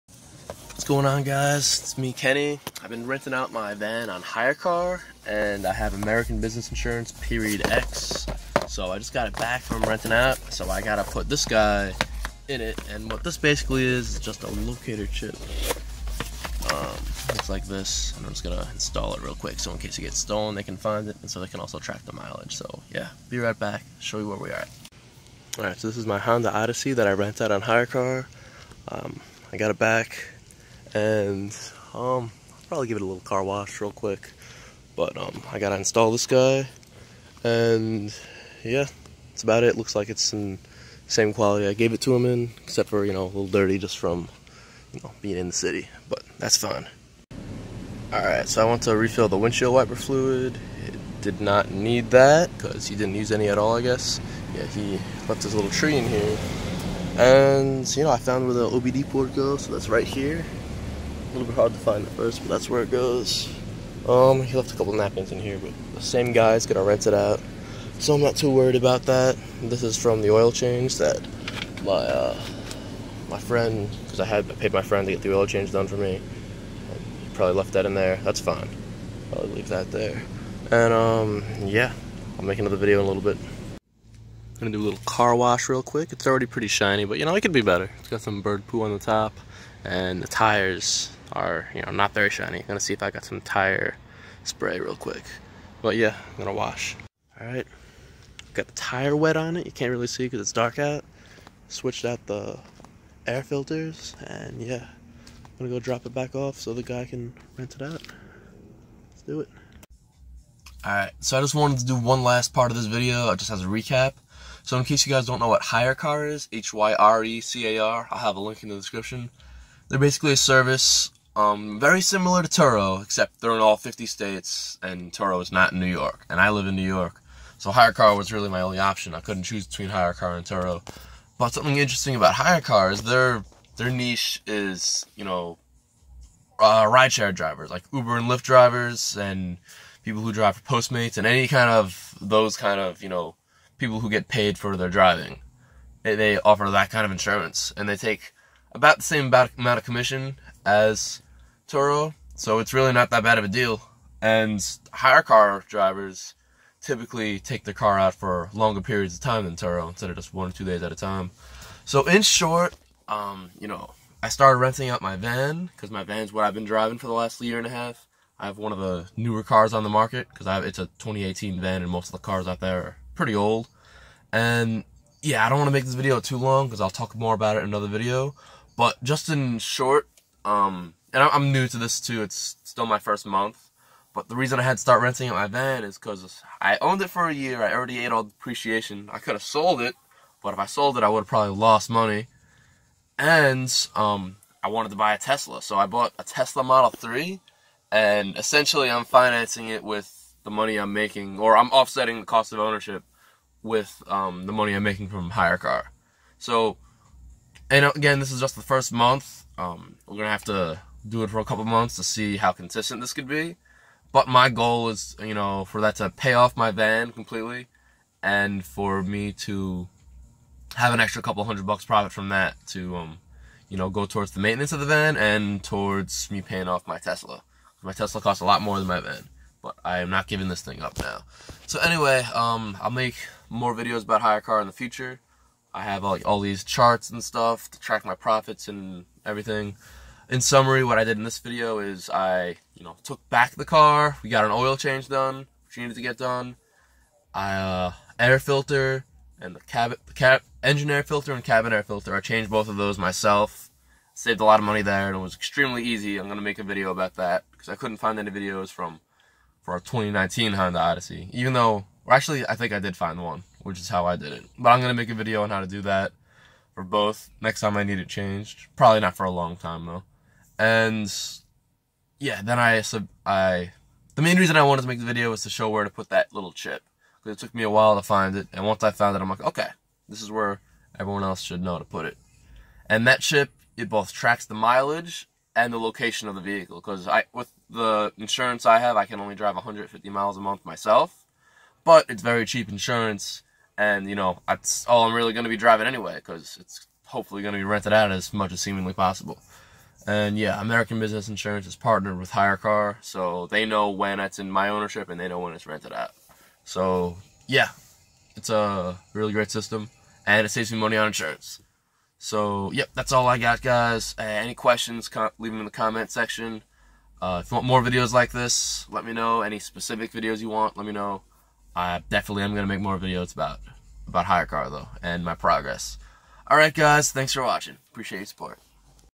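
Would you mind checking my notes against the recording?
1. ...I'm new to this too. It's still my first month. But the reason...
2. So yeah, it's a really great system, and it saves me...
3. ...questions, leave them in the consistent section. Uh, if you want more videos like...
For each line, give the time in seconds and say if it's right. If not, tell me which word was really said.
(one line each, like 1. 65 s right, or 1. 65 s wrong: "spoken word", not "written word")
1. 181 s right
2. 306 s right
3. 314 s wrong: "comment", not "consistent".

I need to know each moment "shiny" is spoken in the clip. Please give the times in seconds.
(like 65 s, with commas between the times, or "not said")
86 s, 92 s.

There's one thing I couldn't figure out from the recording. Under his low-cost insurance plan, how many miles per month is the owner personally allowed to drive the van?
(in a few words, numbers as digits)
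150 miles.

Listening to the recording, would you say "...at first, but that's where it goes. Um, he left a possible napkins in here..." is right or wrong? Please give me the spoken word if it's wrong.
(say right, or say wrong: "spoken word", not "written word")
wrong: "couple", not "possible".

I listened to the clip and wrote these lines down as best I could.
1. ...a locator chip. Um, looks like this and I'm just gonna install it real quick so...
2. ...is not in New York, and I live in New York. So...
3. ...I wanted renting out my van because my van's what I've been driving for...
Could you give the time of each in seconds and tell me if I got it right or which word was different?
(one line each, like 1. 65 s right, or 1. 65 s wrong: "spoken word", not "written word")
1. 14 s right
2. 125 s right
3. 164 s wrong: "started", not "wanted".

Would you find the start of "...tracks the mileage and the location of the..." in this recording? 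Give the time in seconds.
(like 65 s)
284 s.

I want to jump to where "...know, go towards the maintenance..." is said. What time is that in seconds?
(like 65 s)
223 s.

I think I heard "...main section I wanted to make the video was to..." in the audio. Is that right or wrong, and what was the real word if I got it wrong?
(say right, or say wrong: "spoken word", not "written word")
wrong: "reason", not "section".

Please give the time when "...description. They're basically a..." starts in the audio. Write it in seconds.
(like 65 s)
118 s.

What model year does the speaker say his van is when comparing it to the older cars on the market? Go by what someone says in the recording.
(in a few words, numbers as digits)
2018.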